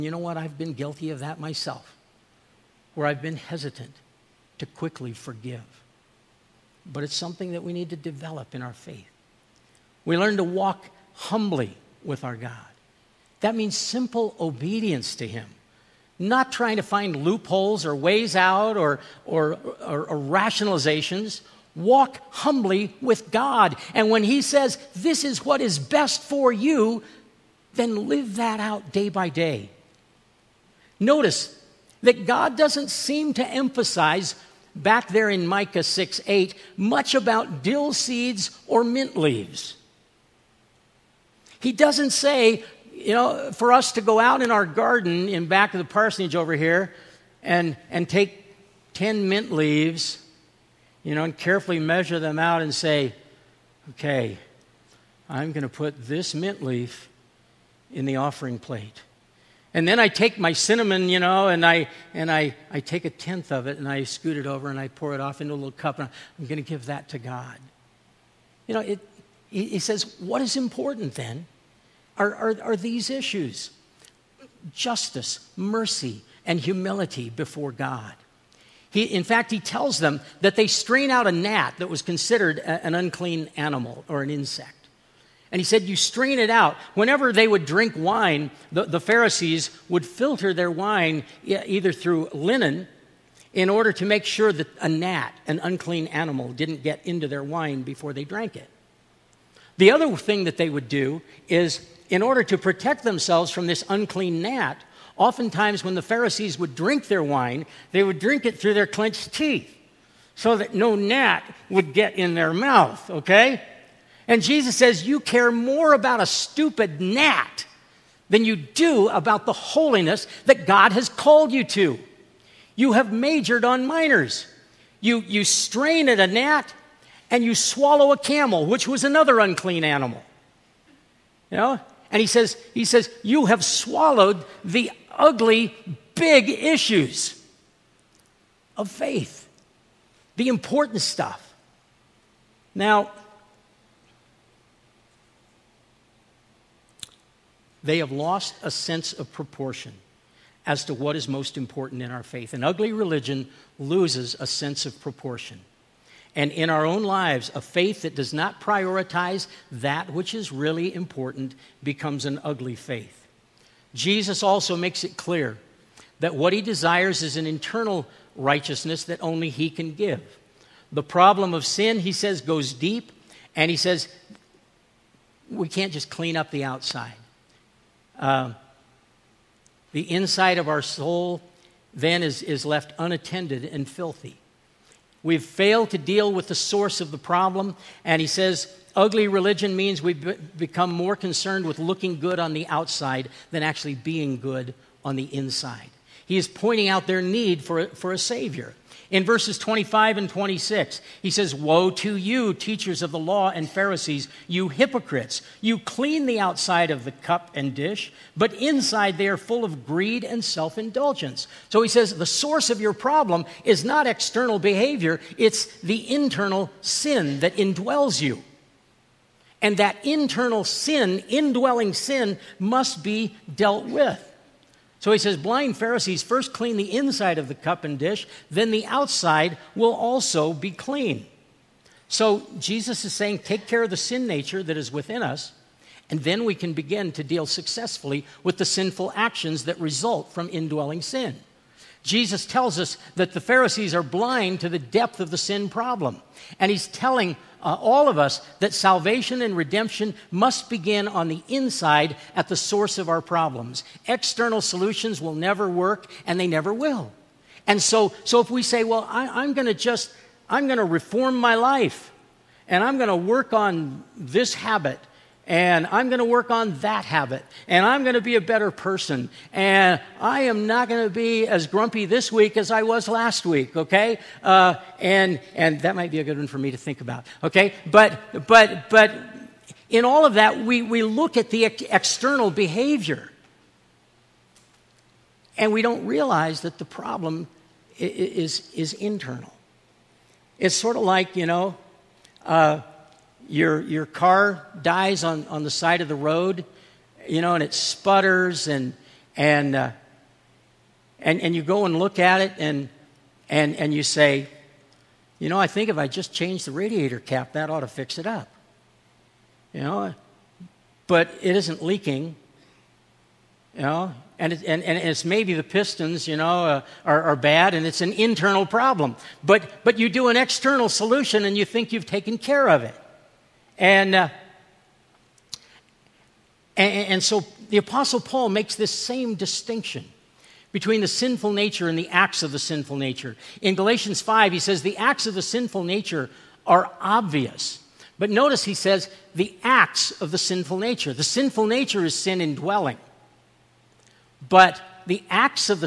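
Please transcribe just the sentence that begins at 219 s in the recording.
And that internal sin, indwelling sin, must be dealt with.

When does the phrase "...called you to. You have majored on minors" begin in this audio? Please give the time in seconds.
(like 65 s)
121 s.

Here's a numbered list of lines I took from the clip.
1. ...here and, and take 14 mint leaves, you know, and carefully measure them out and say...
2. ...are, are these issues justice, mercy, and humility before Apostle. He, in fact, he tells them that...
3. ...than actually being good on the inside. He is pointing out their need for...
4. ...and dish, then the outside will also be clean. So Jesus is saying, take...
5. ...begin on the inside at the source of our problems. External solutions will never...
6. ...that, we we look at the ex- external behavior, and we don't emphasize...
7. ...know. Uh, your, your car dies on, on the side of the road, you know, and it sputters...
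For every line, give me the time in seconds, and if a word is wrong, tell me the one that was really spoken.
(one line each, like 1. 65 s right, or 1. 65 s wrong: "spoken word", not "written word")
1. 46 s wrong: "10", not "14"
2. 72 s wrong: "God", not "Apostle"
3. 193 s right
4. 227 s right
5. 250 s right
6. 280 s wrong: "realize", not "emphasize"
7. 291 s right.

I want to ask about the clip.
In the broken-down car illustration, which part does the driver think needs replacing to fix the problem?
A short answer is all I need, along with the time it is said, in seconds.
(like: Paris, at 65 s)
radiator cap, at 306 s.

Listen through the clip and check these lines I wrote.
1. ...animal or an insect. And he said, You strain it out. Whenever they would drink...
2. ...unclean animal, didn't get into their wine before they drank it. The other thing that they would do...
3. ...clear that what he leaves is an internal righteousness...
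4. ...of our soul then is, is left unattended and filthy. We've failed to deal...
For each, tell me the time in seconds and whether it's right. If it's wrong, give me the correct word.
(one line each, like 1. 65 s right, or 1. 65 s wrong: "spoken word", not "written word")
1. 83 s right
2. 95 s right
3. 165 s wrong: "desires", not "leaves"
4. 180 s right.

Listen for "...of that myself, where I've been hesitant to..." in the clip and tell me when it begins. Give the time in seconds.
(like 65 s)
1 s.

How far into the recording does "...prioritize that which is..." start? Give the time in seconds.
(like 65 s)
158 s.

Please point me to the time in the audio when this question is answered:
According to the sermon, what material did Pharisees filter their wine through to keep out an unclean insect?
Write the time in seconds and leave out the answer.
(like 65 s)
92 s.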